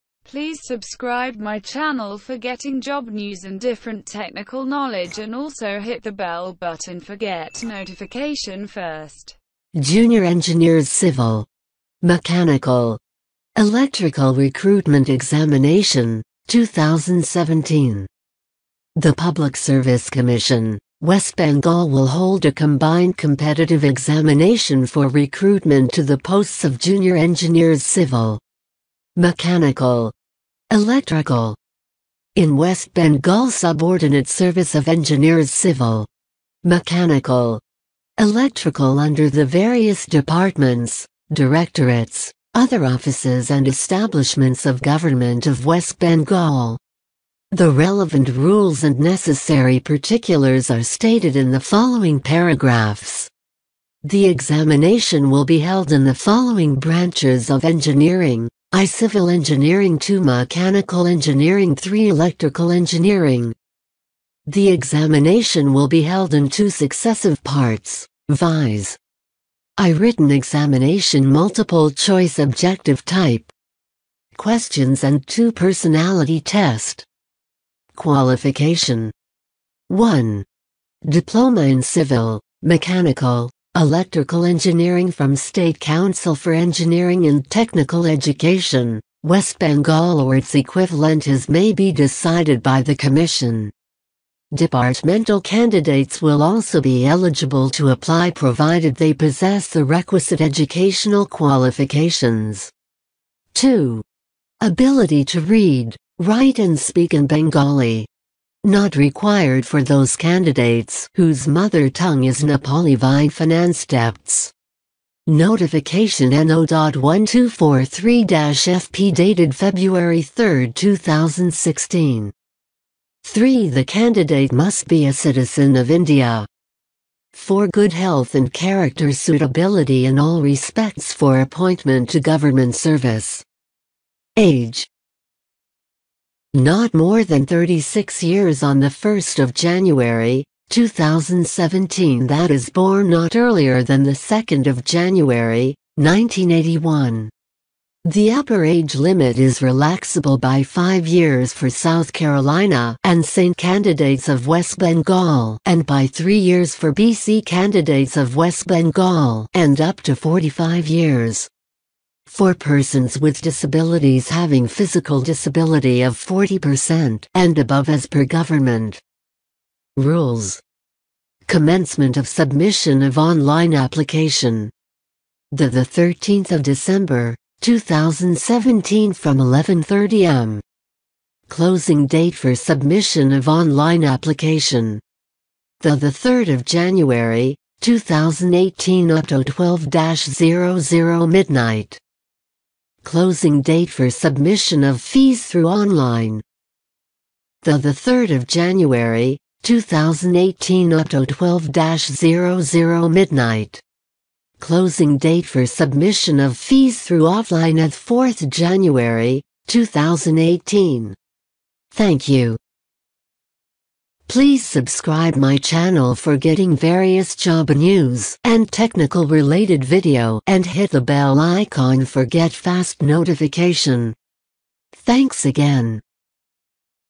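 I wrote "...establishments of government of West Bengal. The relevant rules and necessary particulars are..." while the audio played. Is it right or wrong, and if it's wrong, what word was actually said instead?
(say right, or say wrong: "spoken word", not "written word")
right.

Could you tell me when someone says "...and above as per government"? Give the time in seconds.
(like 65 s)
167 s.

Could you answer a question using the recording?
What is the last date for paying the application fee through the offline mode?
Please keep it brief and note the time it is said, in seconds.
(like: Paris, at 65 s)
4 January 2018, at 207 s.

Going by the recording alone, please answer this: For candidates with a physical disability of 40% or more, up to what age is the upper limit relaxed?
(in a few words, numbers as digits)
45 years.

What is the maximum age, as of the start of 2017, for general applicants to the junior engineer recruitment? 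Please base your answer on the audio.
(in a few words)
36 years.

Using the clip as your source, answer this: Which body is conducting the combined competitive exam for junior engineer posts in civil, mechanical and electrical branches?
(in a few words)
Public Service Commission West Bengal.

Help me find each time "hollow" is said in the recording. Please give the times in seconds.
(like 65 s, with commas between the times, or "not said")
not said.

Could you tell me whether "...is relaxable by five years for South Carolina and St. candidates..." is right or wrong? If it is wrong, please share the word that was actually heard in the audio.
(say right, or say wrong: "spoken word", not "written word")
right.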